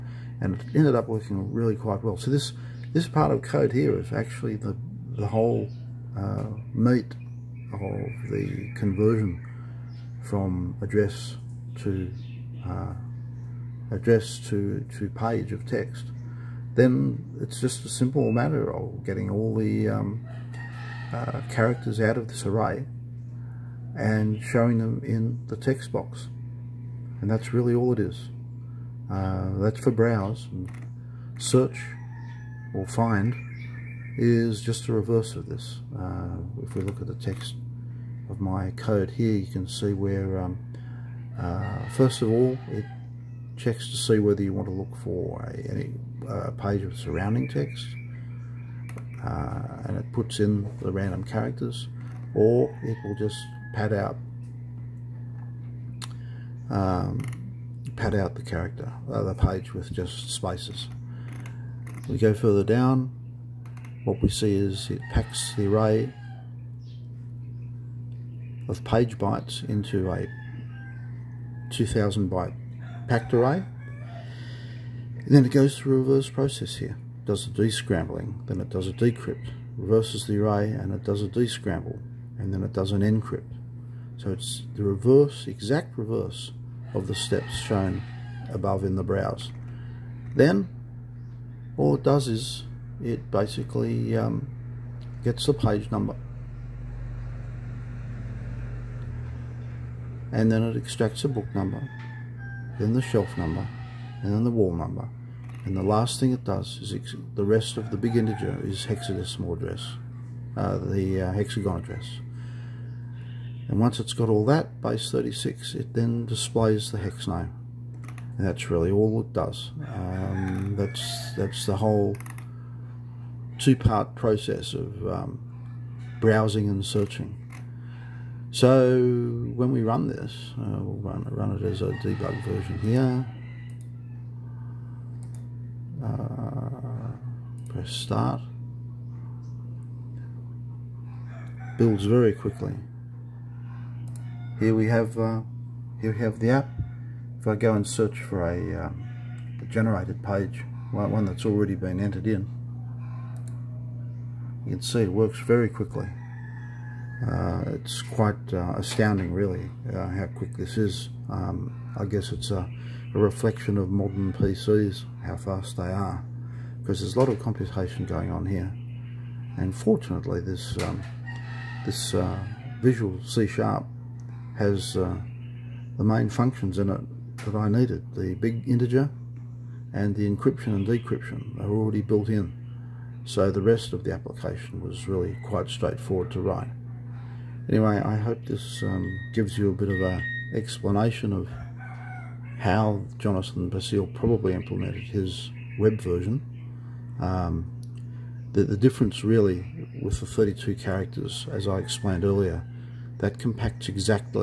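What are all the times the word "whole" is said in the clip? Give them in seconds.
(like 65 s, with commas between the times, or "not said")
5 s, 121 s.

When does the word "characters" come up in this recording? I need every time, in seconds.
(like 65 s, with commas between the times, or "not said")
21 s, 51 s, 58 s, 200 s.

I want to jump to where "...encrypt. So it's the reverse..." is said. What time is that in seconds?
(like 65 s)
82 s.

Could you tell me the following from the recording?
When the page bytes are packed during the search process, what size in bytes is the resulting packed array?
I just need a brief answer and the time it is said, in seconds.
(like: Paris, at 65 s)
2000, at 71 s.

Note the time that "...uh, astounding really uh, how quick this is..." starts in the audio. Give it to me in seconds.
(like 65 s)
158 s.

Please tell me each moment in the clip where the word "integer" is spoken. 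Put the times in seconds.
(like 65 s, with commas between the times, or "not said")
108 s, 178 s.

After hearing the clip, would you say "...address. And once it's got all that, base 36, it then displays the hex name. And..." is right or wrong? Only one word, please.
right.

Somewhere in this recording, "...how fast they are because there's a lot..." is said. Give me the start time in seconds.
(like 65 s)
165 s.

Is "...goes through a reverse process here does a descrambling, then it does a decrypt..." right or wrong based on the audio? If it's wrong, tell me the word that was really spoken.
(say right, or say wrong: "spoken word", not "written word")
right.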